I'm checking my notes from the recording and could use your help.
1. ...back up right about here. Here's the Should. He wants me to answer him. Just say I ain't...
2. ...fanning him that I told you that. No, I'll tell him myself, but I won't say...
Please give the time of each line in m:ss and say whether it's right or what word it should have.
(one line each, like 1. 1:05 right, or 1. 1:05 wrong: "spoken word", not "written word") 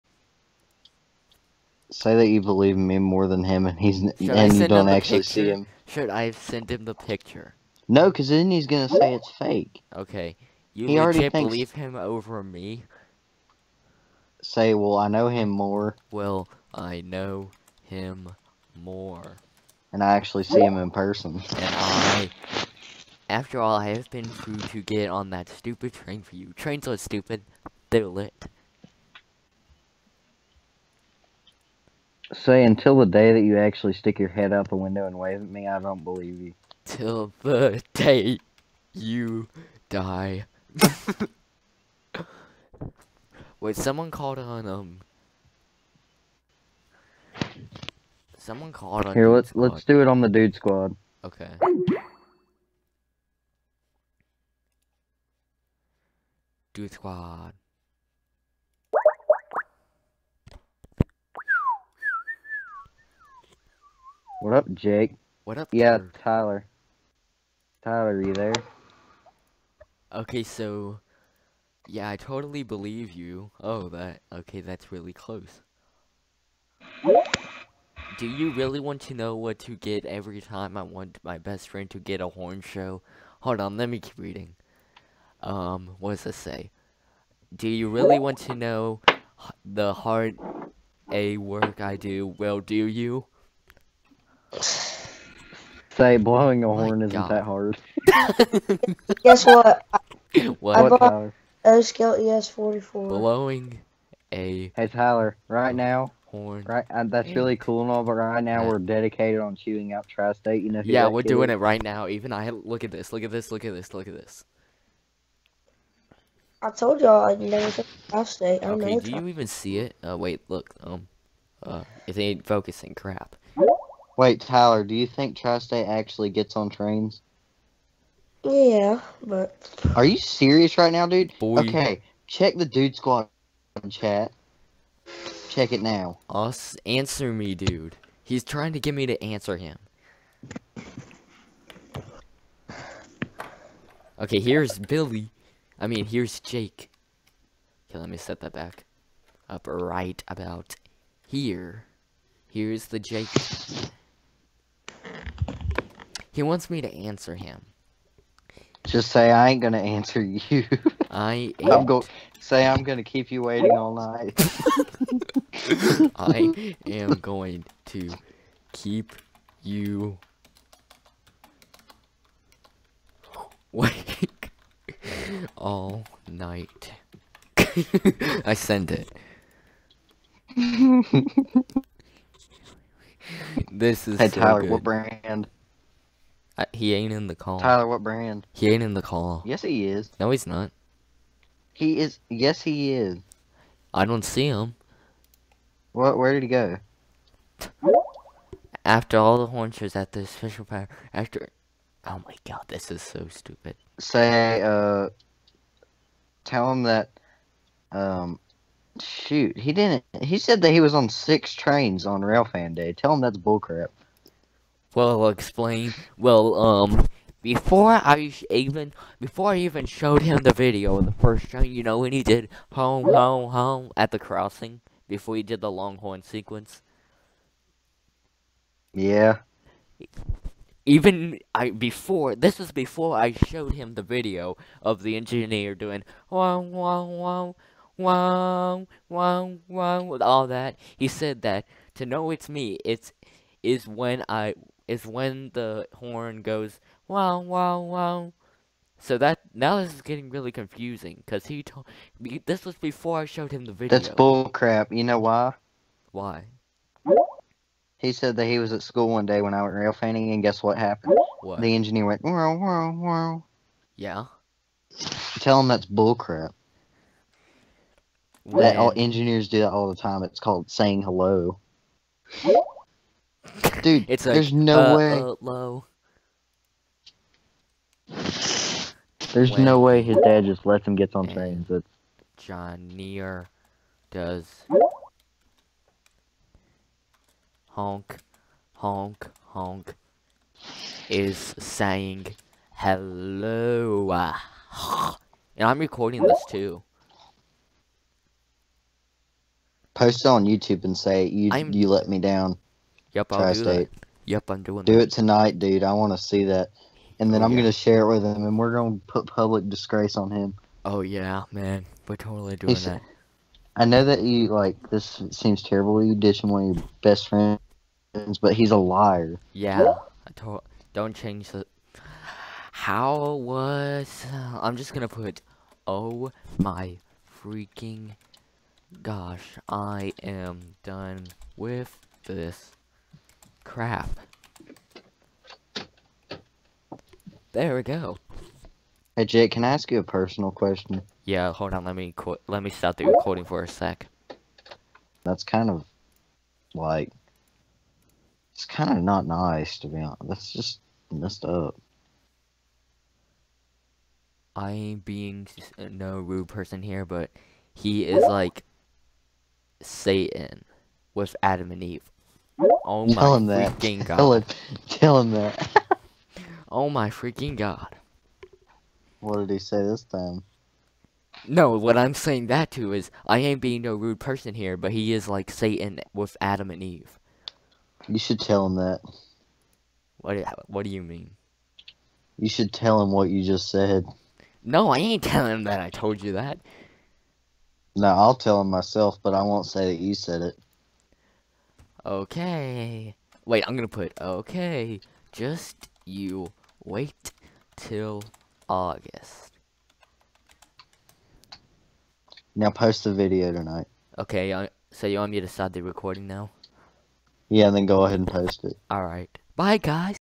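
1. 2:28 wrong: "Jake", not "Should"
2. 6:25 wrong: "telling", not "fanning".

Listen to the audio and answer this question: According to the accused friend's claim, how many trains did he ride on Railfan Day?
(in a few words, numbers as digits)
6.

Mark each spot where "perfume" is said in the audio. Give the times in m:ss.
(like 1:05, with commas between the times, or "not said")
not said.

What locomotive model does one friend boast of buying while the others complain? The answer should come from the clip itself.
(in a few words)
ES44.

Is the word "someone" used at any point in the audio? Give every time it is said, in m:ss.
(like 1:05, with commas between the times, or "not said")
0:43, 0:48.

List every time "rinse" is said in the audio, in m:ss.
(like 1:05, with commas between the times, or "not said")
not said.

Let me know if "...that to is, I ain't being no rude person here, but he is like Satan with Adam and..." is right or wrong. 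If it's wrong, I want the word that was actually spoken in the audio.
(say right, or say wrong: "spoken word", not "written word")
right.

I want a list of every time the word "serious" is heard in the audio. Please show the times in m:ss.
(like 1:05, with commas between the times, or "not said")
2:10.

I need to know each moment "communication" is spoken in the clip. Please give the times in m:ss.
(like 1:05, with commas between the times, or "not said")
not said.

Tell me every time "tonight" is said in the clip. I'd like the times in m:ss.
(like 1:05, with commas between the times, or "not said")
5:05, 6:43.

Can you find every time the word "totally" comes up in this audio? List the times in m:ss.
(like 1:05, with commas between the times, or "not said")
1:12, 5:12.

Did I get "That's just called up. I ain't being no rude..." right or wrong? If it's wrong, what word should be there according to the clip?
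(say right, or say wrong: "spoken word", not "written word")
wrong: "messed", not "called".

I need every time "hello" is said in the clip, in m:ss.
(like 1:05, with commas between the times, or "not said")
4:31, 4:52.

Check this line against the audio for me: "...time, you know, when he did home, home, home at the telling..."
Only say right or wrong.
wrong.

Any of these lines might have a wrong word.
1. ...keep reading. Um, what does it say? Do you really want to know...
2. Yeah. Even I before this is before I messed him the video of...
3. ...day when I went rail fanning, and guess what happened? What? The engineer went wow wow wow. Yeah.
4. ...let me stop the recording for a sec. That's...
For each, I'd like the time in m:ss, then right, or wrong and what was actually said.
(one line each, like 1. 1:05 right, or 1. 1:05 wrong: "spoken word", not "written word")
1. 1:23 right
2. 3:48 wrong: "showed", not "messed"
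3. 4:19 right
4. 5:42 right.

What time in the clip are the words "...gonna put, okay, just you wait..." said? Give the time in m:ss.
6:33.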